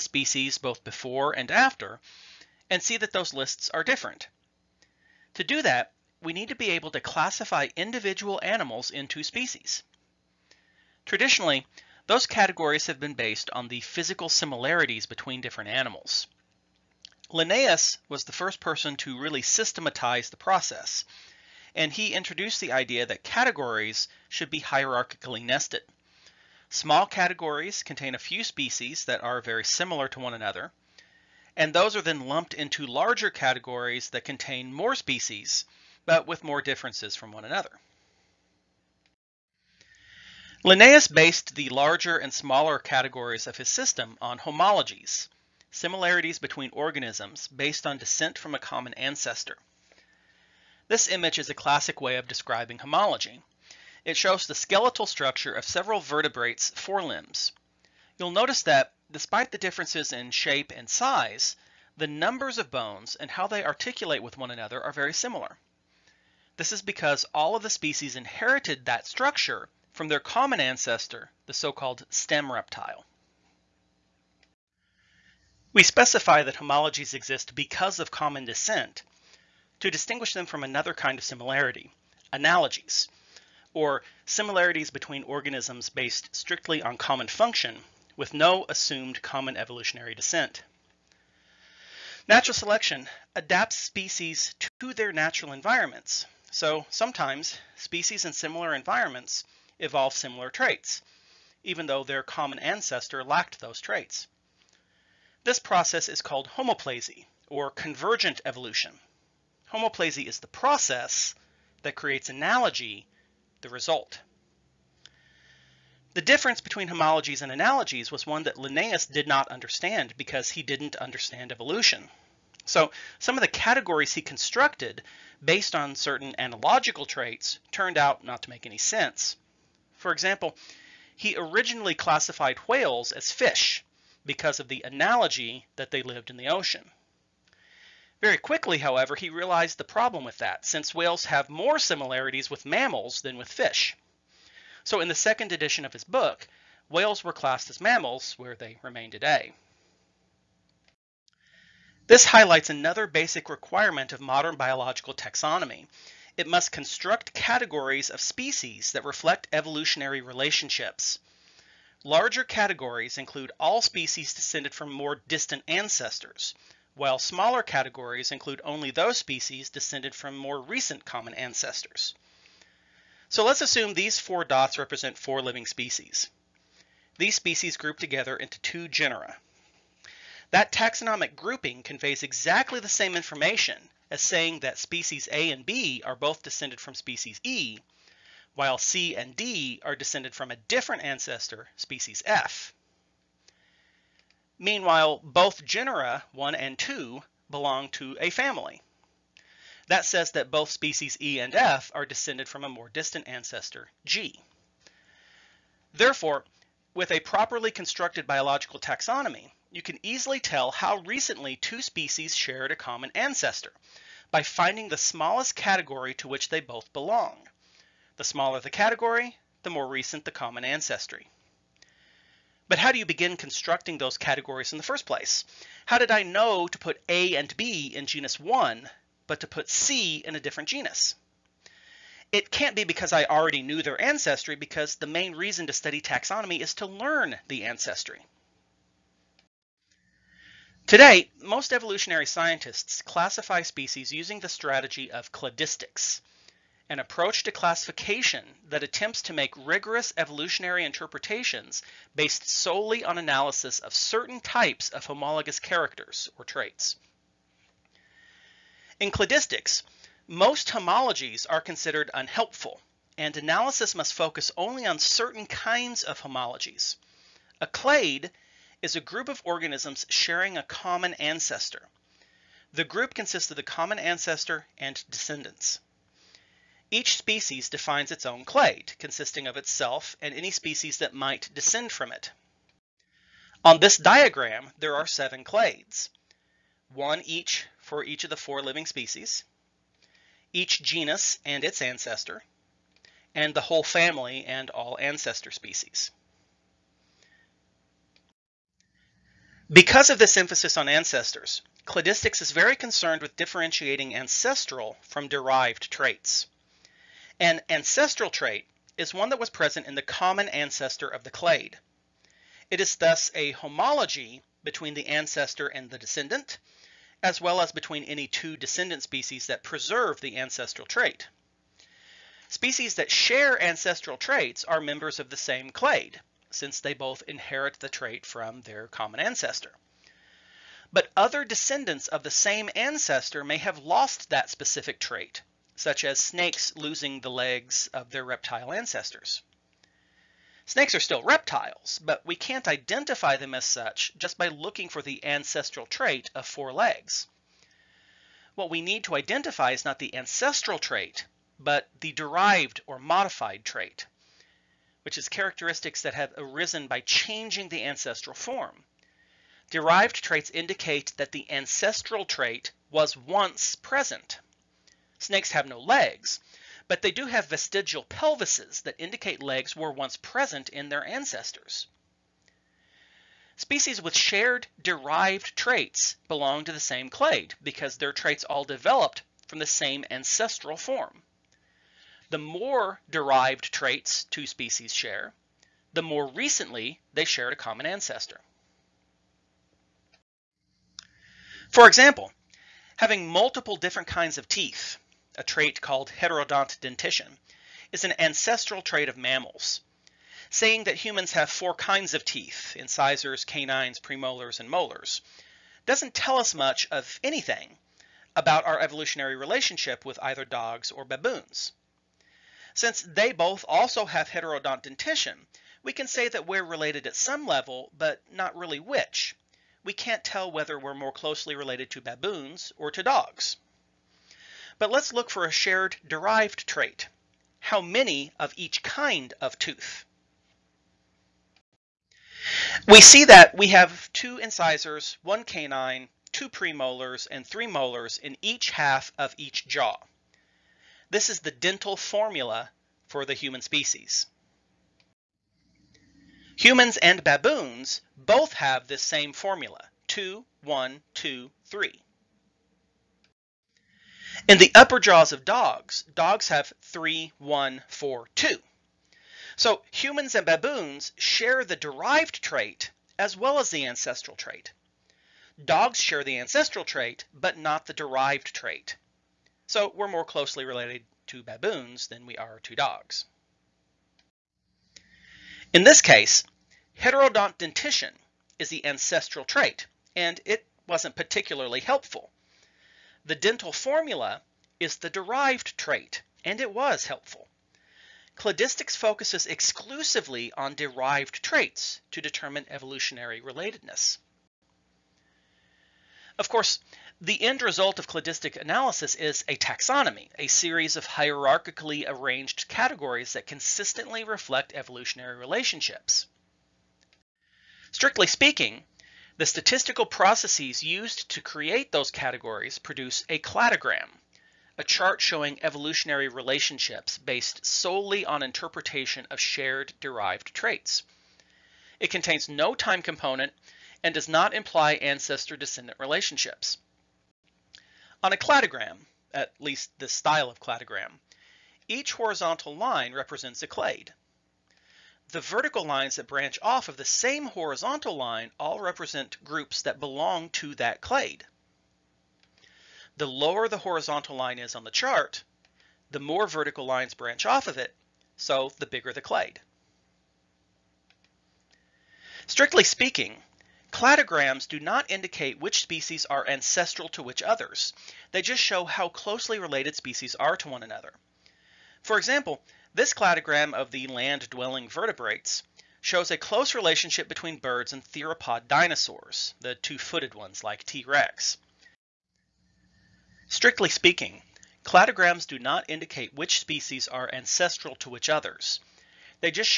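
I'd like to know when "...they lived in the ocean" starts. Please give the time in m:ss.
2:15.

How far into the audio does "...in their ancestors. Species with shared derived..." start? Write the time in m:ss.
6:10.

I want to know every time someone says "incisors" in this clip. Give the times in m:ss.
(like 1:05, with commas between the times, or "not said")
6:42, 7:14.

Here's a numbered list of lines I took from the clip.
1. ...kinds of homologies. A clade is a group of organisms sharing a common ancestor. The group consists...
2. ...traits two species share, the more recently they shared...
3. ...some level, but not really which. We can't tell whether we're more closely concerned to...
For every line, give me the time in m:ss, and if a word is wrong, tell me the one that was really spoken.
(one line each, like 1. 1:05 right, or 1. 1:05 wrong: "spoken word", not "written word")
1. 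4:25 right
2. 6:23 right
3. 6:57 wrong: "related", not "concerned".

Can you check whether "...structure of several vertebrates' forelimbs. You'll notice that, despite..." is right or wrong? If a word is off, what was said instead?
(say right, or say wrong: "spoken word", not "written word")
right.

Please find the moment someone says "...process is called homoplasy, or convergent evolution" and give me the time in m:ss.
1:45.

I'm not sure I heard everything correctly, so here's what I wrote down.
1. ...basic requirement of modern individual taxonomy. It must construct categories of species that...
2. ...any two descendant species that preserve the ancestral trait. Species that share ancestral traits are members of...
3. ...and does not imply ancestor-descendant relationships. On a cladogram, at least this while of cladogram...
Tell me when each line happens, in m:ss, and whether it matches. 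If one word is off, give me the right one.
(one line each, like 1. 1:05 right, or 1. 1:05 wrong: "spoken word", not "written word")
1. 2:33 wrong: "biological", not "individual"
2. 5:18 right
3. 8:44 wrong: "style", not "while".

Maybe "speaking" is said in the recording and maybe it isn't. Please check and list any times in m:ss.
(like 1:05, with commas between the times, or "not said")
8:28, 9:12, 9:33.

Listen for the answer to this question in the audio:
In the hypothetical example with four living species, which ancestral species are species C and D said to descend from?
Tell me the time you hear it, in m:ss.
3:11.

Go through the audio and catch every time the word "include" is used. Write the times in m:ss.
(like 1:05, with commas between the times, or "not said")
2:43, 2:48.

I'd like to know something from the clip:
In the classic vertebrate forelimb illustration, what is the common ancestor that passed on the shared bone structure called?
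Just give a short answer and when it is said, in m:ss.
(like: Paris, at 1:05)
stem reptile, at 1:11.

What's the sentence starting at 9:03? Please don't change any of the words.
The lower the horizontal line is on the chart, the more vertical lines branch off of it, so the bigger the clade.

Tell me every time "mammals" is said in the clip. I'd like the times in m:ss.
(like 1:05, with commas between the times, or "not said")
2:22, 2:27, 6:39.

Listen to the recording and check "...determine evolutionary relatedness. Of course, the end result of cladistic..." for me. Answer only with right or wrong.
right.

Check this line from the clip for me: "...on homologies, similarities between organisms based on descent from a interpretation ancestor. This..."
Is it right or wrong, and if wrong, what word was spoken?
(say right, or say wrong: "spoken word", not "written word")
wrong: "common", not "interpretation".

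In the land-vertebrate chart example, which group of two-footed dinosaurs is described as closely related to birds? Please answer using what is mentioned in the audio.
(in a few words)
theropod dinosaurs.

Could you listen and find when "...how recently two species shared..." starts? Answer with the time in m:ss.
3:30.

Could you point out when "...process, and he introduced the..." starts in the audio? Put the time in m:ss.
0:20.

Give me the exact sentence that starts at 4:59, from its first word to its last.
Because of this emphasis on ancestors, cladistics is very concerned with differentiating ancestral from derived traits.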